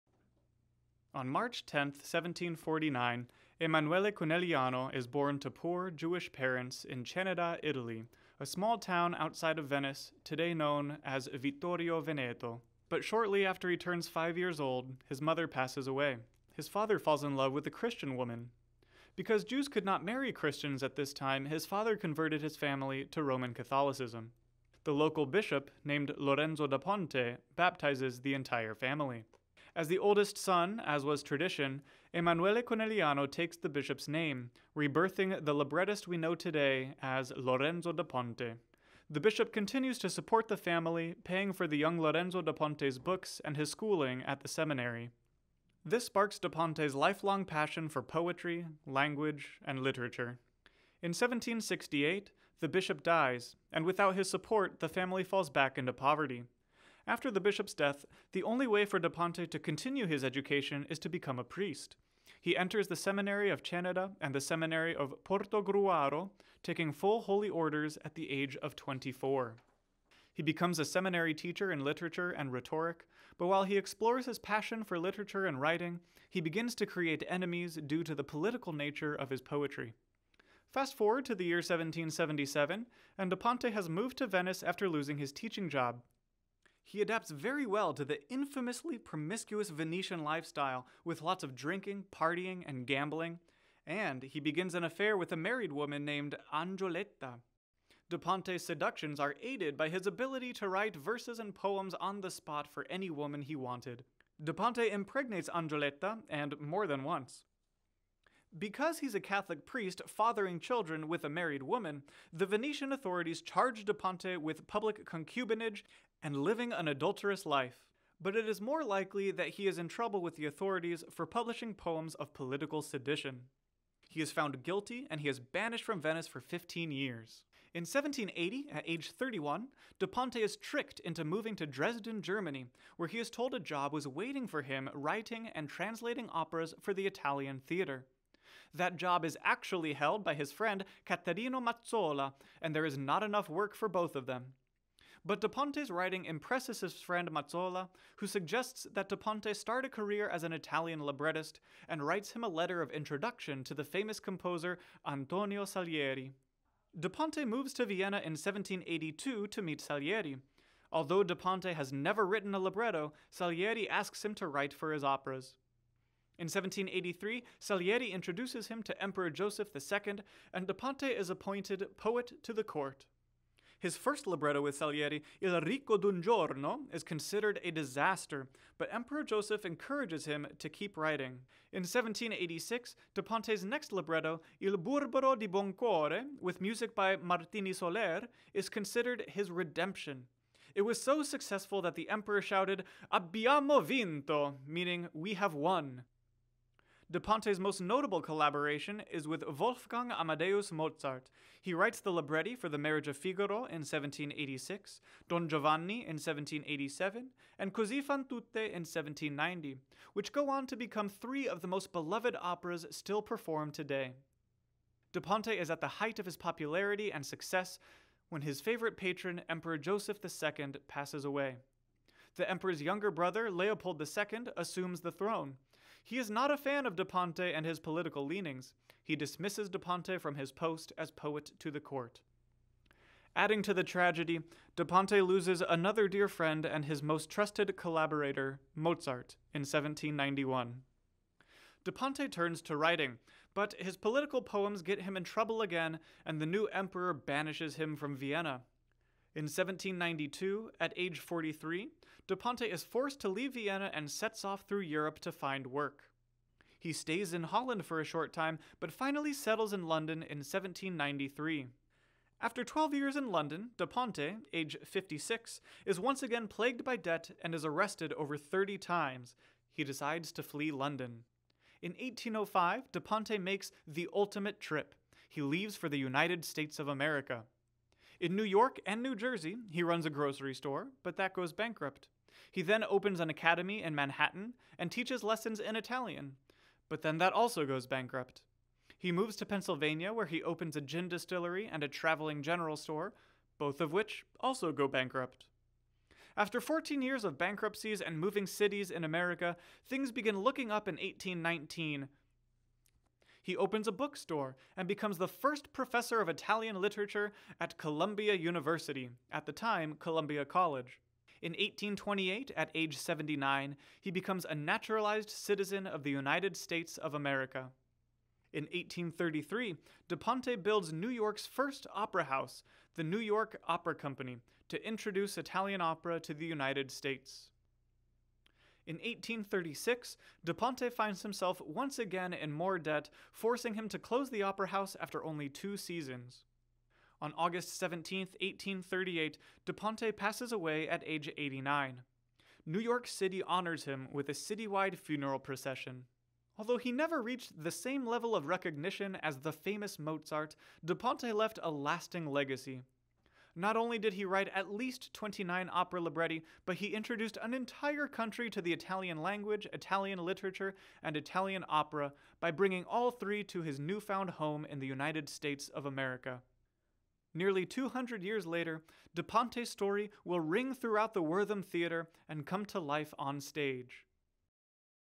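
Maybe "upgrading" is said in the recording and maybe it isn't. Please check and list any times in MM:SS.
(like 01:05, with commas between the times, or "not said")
not said.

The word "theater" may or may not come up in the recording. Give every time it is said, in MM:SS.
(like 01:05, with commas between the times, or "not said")
02:17, 06:11.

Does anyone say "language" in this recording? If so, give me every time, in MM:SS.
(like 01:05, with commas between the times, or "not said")
00:48, 05:59.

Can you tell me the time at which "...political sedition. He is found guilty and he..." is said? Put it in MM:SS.
02:02.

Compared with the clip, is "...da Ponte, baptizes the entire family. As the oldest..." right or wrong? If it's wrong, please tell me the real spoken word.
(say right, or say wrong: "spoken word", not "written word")
right.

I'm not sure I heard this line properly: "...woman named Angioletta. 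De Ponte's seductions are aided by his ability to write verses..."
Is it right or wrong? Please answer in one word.
right.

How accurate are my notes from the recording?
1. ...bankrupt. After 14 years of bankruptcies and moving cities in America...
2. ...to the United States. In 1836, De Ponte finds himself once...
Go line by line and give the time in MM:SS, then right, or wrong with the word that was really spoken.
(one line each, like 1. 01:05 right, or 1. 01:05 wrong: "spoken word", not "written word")
1. 04:54 right
2. 05:26 right.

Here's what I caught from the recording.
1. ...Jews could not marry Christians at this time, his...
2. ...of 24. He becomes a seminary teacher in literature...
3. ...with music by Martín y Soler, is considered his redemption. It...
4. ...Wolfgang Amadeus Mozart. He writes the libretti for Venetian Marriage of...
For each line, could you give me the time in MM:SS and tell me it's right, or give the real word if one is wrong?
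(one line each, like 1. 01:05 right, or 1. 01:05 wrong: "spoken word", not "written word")
1. 00:19 right
2. 01:08 right
3. 03:06 right
4. 03:19 wrong: "The", not "Venetian".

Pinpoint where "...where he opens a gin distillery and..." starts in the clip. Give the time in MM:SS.
04:50.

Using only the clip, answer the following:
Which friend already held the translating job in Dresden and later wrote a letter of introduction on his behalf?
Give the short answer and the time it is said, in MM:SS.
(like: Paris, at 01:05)
Caterino Mazzola, at 02:21.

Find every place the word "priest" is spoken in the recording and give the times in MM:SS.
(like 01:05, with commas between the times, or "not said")
01:01, 01:49.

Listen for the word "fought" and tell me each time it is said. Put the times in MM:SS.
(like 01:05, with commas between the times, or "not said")
not said.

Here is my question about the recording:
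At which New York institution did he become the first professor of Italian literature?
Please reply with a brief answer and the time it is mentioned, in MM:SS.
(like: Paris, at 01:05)
Columbia University, at 05:07.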